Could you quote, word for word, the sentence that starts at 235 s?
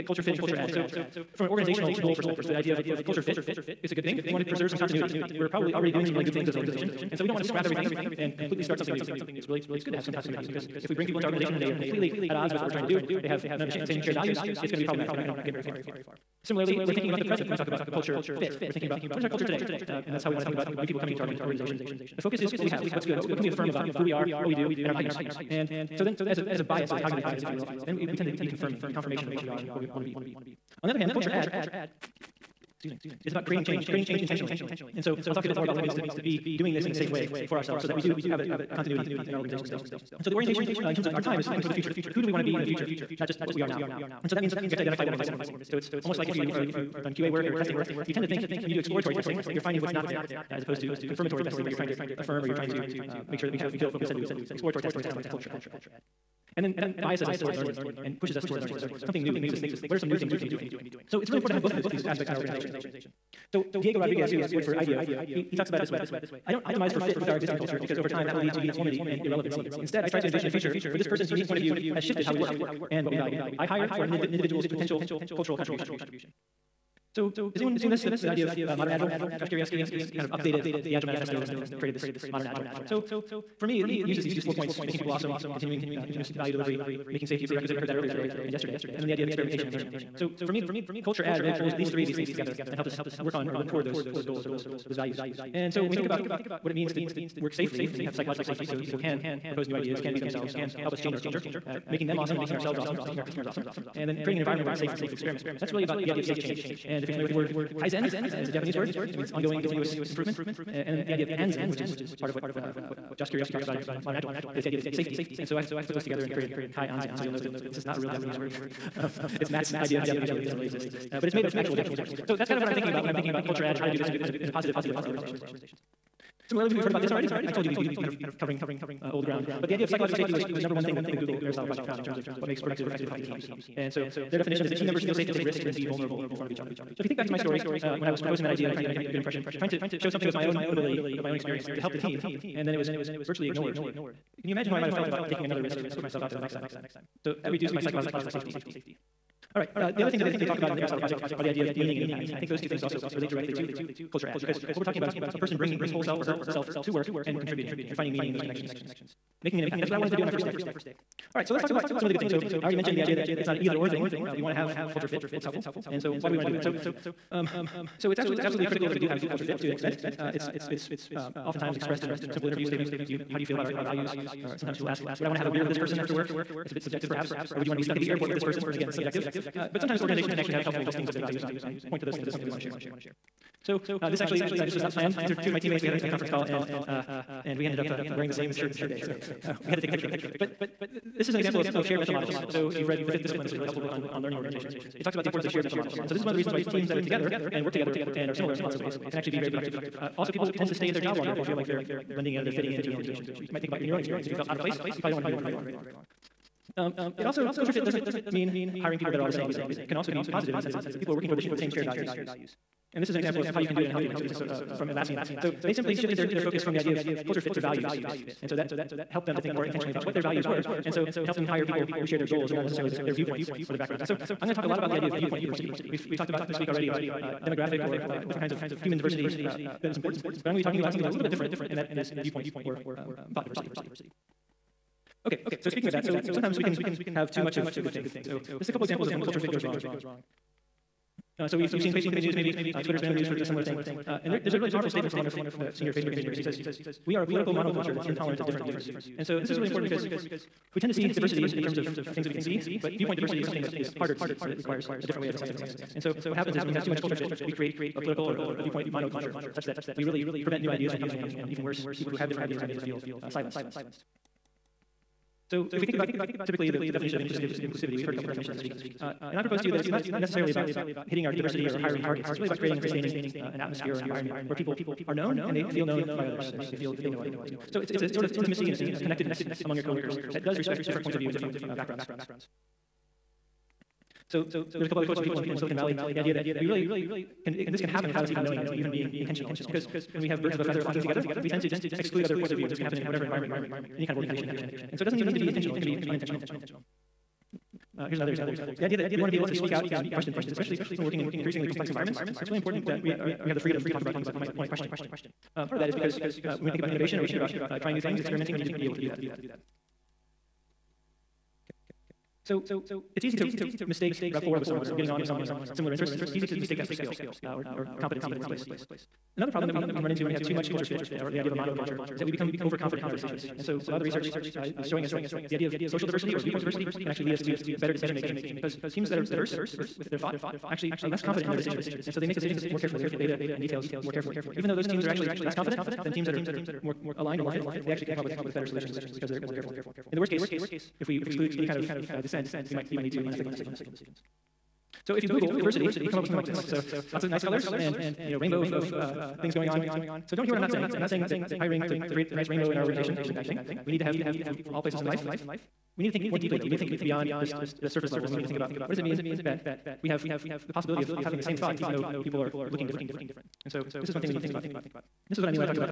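Okay, so speaking of that, so sometimes we can have too much of a good thing.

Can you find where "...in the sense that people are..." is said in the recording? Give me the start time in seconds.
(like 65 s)
210 s.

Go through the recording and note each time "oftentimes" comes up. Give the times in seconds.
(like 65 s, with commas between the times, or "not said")
171 s.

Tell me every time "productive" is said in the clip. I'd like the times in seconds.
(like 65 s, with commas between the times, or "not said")
132 s, 199 s.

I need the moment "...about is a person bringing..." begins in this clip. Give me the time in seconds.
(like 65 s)
154 s.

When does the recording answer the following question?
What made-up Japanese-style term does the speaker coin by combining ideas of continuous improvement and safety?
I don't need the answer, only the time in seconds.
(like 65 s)
116 s.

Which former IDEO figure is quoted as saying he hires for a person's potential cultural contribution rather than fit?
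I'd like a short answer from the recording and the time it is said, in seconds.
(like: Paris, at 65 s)
Diego Rodriguez, at 63 s.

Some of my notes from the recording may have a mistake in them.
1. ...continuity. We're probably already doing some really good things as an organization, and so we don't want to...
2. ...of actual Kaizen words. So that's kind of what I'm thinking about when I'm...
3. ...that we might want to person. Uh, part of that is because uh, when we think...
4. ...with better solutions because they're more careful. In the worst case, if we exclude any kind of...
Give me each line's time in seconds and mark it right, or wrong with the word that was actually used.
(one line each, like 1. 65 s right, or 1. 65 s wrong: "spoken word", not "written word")
1. 4 s right
2. 121 s wrong: "Japanese", not "Kaizen"
3. 304 s wrong: "question", not "person"
4. 338 s right.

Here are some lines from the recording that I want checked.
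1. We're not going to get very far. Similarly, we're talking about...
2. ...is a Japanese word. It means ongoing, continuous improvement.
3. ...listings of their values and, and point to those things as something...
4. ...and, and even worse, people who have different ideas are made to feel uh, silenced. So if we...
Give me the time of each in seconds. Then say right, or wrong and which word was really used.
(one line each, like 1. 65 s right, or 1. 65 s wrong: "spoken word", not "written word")
1. 15 s wrong: "thinking", not "talking"
2. 108 s right
3. 180 s right
4. 261 s right.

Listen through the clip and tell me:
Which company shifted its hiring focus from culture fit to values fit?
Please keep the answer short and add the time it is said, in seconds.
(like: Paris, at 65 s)
Atlassian, at 214 s.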